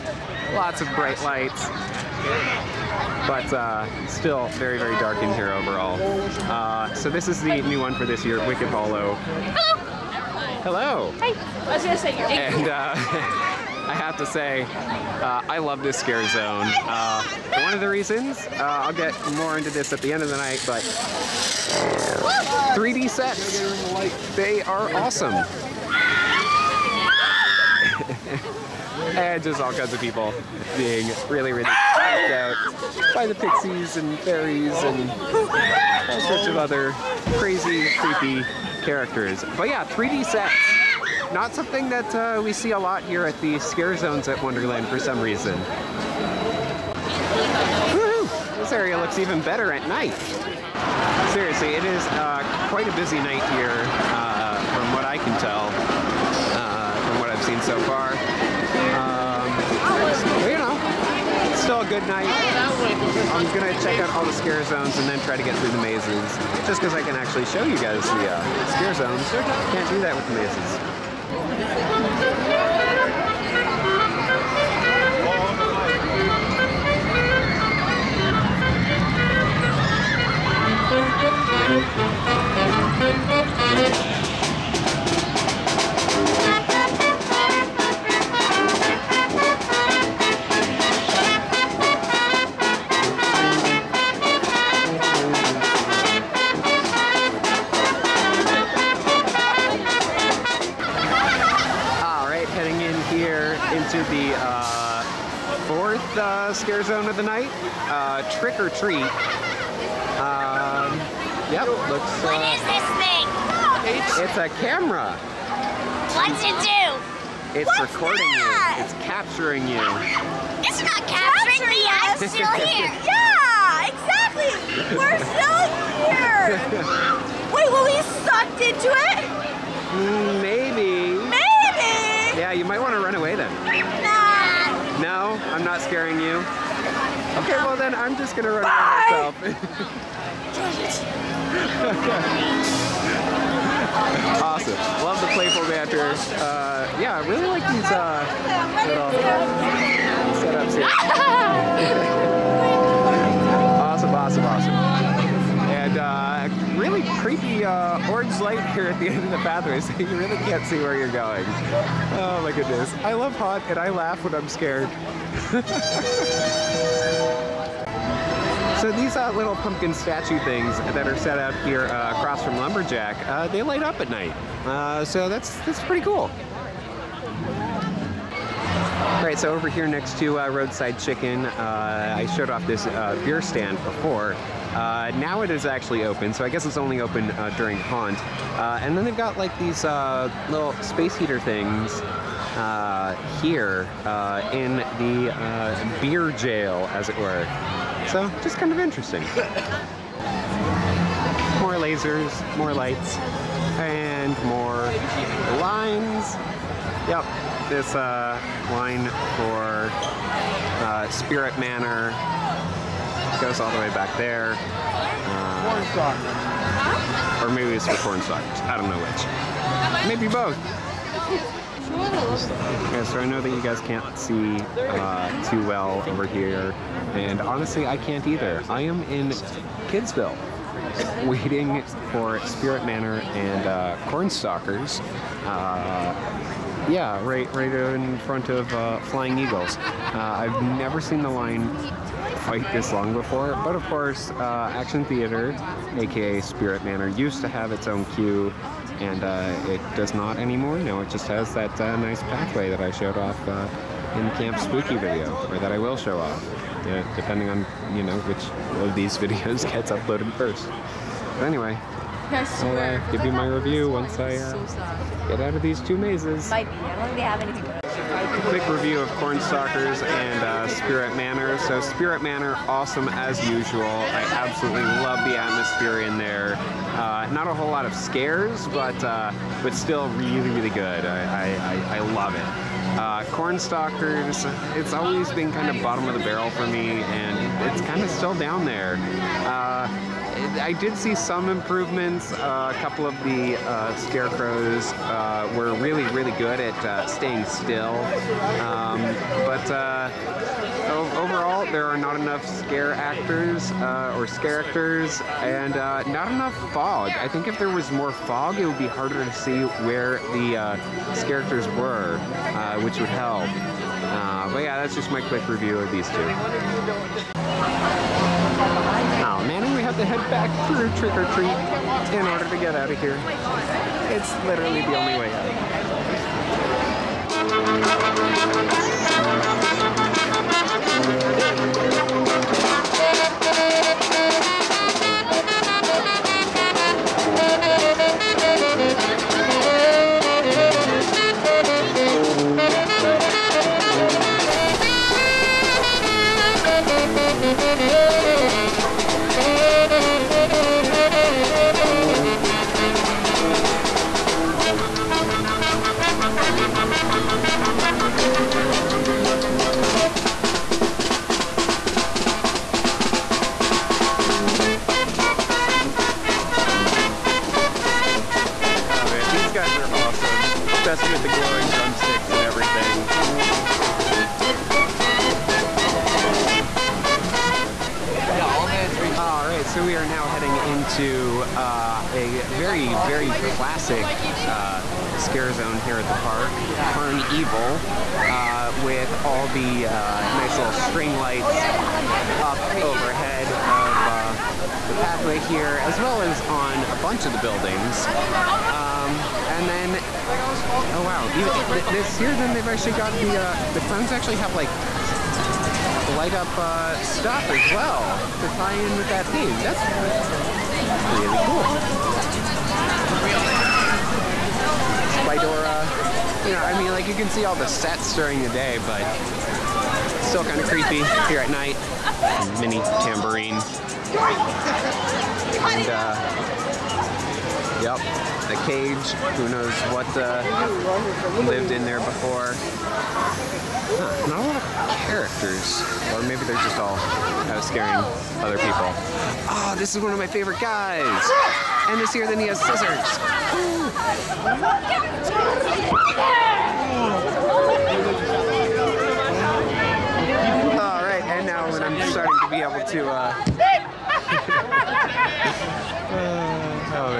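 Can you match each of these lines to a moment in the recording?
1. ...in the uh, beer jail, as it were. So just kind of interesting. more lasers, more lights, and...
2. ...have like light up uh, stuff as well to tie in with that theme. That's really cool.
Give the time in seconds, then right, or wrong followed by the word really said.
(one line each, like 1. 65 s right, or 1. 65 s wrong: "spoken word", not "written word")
1. 194 s right
2. 404 s right.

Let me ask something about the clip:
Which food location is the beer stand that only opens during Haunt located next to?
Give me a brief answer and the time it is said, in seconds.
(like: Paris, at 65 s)
Roadside Chicken, at 180 s.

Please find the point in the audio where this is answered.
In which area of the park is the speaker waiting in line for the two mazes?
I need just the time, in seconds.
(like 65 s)
229 s.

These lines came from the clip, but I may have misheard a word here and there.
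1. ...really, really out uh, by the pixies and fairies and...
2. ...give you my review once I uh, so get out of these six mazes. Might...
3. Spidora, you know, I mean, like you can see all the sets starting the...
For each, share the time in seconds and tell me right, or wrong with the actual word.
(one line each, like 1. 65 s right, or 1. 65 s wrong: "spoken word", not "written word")
1. 31 s right
2. 263 s wrong: "two", not "six"
3. 415 s wrong: "during", not "starting".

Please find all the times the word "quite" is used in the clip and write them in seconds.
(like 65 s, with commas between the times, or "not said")
52 s, 242 s.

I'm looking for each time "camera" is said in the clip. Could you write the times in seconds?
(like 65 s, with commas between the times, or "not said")
114 s.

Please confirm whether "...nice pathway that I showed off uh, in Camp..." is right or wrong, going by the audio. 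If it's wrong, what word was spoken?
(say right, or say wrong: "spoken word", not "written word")
right.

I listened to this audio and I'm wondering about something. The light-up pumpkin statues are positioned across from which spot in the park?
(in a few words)
Lumberjack.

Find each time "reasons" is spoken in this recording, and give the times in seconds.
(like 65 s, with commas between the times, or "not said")
17 s, 45 s.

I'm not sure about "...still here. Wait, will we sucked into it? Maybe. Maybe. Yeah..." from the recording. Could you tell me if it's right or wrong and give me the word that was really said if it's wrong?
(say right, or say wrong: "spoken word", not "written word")
right.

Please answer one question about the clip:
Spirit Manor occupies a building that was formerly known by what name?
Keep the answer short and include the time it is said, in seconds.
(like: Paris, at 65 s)
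Action Theater, at 244 s.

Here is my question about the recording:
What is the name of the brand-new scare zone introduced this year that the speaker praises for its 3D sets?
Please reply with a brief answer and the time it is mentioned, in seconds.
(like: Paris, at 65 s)
Wicked Hollow, at 8 s.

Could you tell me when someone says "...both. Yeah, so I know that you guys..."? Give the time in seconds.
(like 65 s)
220 s.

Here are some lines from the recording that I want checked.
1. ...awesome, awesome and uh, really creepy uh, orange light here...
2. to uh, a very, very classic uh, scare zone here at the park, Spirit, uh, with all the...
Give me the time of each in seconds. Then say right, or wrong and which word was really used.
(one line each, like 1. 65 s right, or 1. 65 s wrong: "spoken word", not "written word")
1. 154 s right
2. 381 s wrong: "CarnEvil", not "Spirit".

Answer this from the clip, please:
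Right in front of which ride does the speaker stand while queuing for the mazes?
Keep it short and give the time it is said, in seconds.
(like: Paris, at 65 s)
Flying Eagles, at 239 s.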